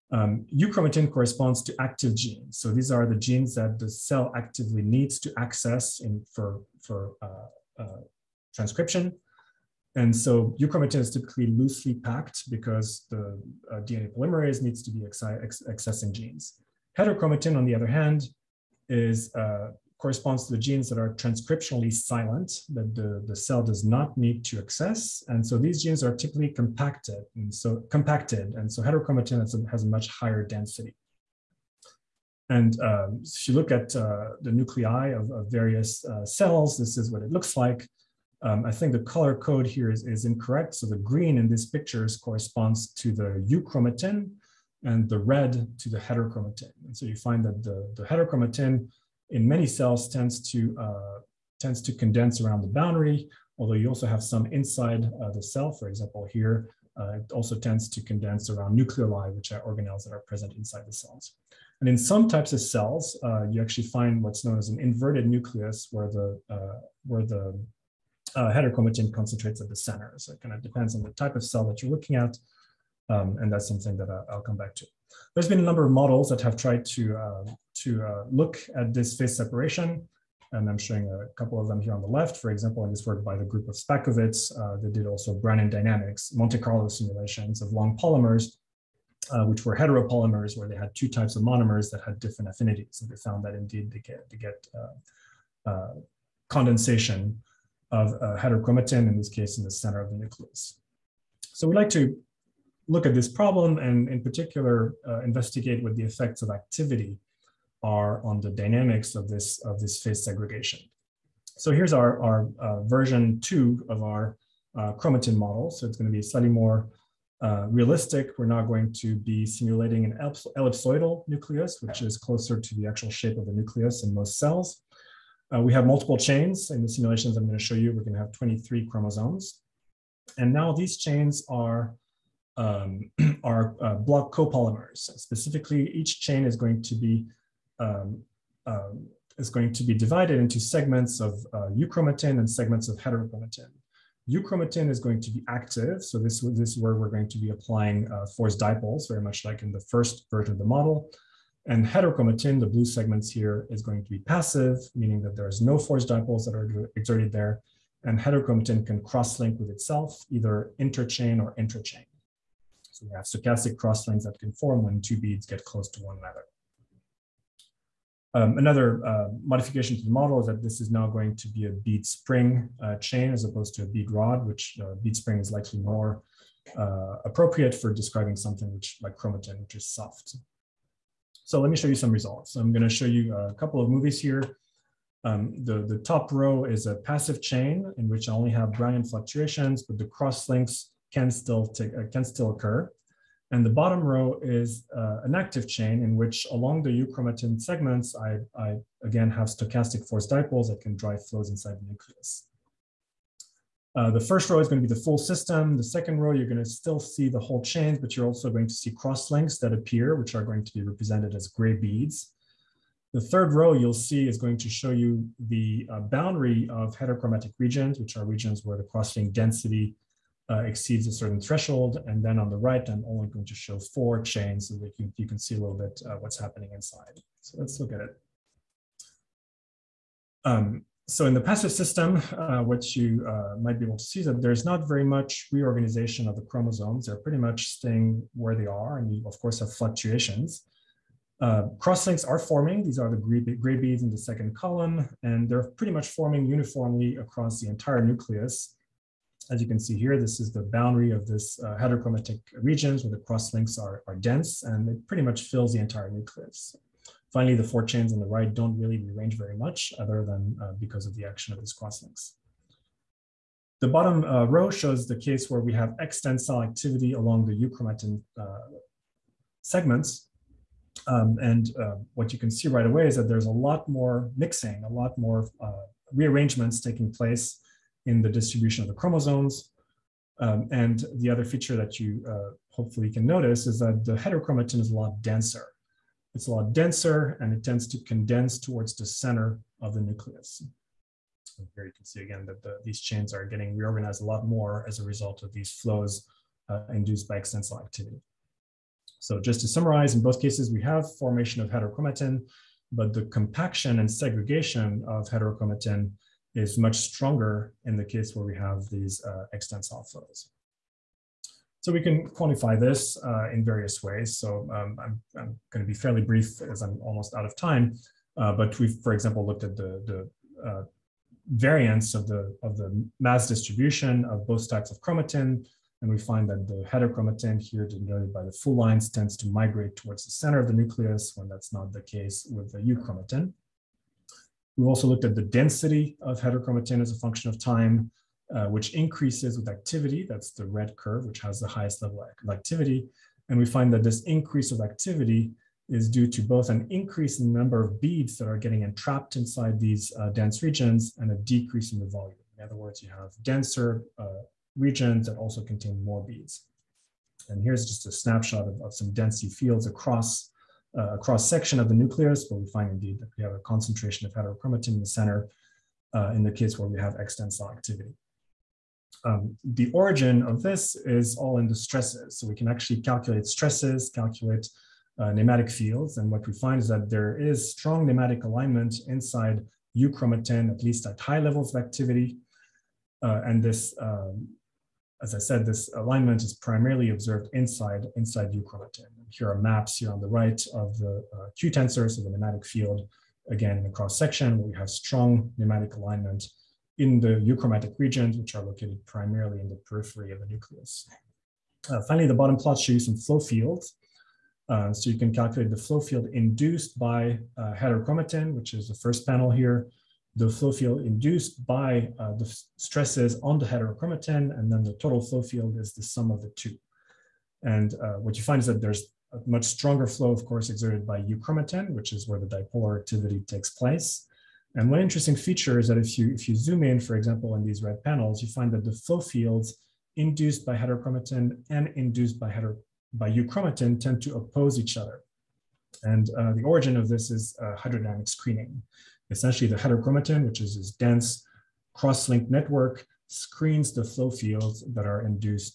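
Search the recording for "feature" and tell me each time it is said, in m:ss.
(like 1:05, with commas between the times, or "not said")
4:41, 7:05.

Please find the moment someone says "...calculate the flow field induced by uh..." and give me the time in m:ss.
6:45.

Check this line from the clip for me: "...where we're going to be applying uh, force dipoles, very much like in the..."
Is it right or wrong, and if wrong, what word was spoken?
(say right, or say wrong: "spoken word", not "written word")
right.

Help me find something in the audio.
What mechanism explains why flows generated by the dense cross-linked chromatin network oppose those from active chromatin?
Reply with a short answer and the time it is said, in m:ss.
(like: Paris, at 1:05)
Hydrodynamic screening, at 7:17.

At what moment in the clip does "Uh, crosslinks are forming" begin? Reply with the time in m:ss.
4:01.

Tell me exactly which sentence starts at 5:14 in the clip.
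So um, I'm, I'm going to be fairly brief as I'm almost out of time.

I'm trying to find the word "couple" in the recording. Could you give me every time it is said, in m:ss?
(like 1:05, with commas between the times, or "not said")
1:21, 3:03.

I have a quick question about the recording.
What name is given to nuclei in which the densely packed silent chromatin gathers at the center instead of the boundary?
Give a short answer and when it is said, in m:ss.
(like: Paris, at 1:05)
Inverted nucleus, at 1:04.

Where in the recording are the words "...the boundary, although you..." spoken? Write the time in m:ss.
0:52.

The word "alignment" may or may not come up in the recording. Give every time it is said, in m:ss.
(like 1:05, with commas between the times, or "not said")
6:18, 6:25, 6:35.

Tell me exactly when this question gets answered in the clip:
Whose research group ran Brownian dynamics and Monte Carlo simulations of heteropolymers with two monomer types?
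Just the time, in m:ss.
1:23.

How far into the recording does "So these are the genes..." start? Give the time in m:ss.
0:02.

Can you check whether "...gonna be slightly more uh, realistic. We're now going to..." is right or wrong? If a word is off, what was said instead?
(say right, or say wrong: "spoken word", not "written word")
right.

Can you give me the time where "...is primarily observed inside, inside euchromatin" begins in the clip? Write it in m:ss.
6:26.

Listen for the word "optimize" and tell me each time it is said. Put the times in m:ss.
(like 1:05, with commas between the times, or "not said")
not said.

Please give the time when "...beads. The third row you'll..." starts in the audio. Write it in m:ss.
3:31.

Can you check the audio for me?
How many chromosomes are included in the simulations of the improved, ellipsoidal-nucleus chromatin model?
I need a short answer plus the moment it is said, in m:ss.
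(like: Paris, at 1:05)
23, at 2:08.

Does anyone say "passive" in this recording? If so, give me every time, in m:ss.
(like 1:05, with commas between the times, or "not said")
2:34, 3:06, 3:51.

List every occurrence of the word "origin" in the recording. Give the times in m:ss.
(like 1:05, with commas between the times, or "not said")
6:09, 7:16.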